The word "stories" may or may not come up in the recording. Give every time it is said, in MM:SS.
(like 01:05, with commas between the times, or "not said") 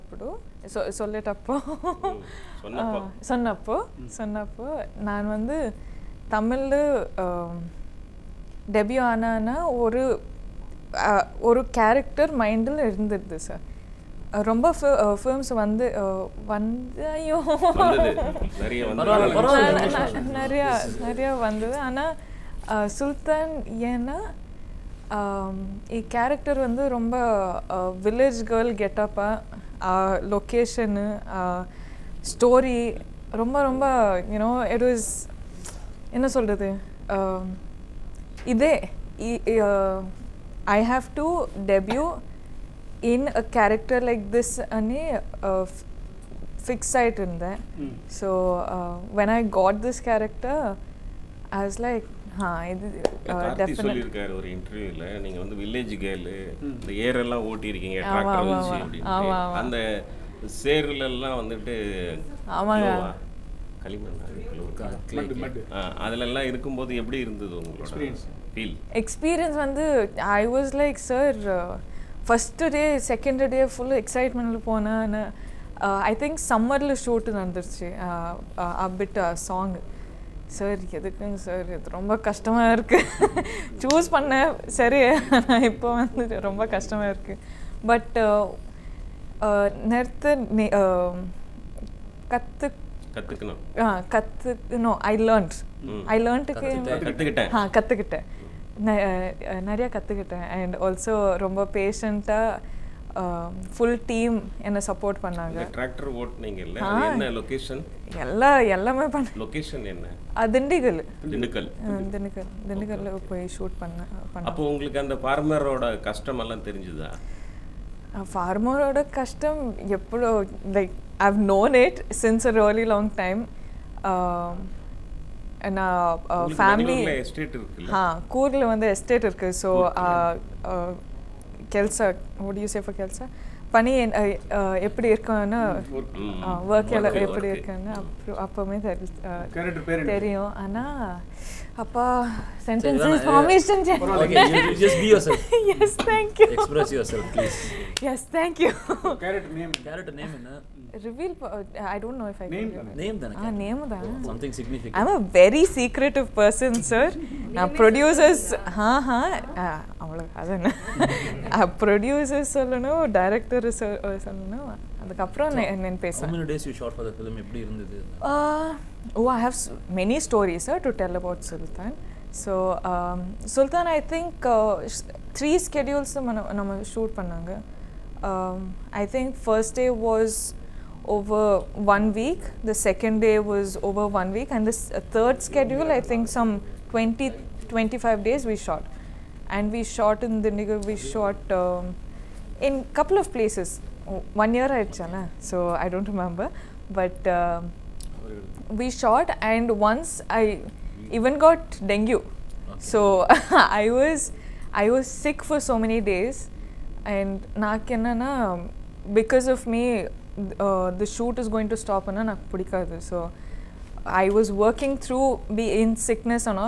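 02:50.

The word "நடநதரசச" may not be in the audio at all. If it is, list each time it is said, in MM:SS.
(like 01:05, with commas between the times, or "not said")
01:17.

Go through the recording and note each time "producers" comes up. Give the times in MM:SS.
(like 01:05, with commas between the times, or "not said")
02:37, 02:41.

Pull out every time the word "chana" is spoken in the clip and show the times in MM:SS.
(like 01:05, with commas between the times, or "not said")
03:14.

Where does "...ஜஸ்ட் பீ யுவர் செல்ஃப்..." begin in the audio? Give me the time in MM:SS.
02:23.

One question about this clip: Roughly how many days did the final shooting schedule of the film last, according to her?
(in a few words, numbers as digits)
20 to 25 days.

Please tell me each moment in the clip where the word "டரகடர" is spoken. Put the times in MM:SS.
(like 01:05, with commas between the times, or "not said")
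00:58, 01:45.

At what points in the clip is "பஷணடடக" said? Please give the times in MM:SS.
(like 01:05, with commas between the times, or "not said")
01:41.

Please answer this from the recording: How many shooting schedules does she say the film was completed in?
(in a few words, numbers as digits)
3.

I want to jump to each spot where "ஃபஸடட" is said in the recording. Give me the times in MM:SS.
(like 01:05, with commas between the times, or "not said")
01:12.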